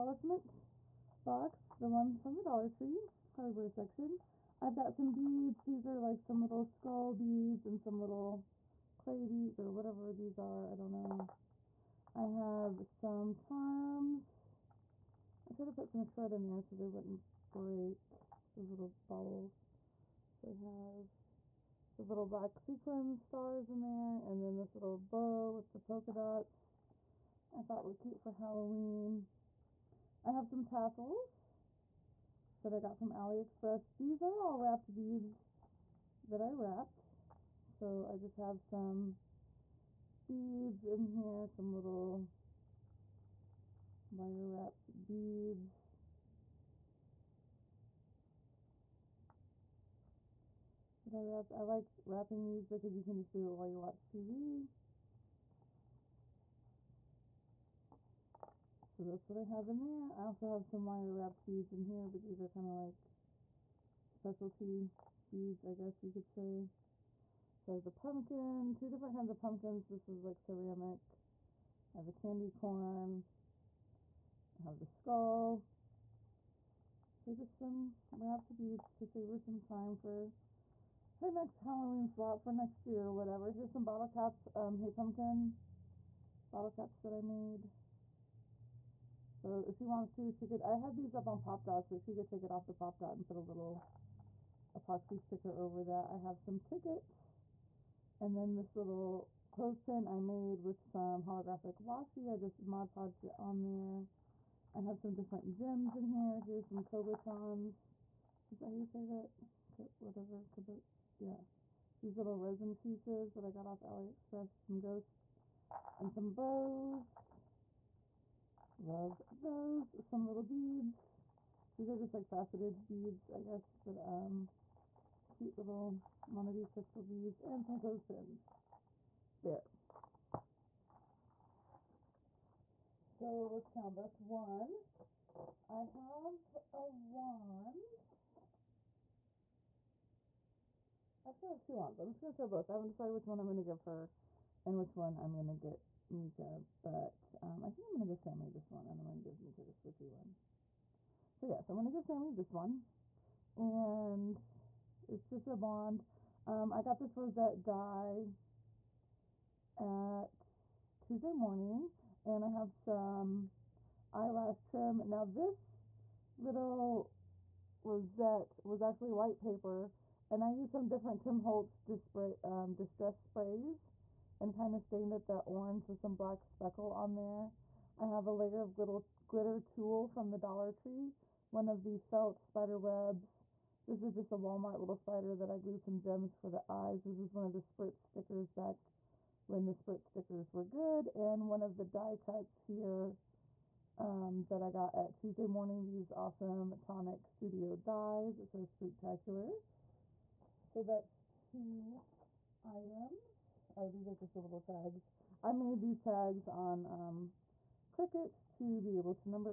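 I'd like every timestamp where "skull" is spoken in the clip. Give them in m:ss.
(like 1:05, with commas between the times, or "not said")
0:06, 1:14.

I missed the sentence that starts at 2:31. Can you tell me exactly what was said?
So yeah, so I'm going to give Sami this one, and it's just a bond.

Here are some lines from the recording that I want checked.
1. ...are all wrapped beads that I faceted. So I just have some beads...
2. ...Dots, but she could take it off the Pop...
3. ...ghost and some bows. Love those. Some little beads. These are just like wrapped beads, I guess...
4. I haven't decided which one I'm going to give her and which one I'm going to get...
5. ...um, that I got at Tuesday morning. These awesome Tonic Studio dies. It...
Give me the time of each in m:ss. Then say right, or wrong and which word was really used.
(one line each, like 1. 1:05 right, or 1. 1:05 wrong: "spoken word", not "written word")
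1. 0:34 wrong: "wrapped", not "faceted"
2. 1:31 right
3. 1:54 wrong: "faceted", not "wrapped"
4. 2:22 right
5. 3:13 right.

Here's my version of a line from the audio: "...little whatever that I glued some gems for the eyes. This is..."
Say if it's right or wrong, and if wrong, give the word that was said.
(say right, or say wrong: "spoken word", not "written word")
wrong: "spider", not "whatever".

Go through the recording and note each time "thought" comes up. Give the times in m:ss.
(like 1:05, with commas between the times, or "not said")
0:27.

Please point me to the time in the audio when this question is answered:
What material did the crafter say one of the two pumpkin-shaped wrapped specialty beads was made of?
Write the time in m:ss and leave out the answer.
1:10.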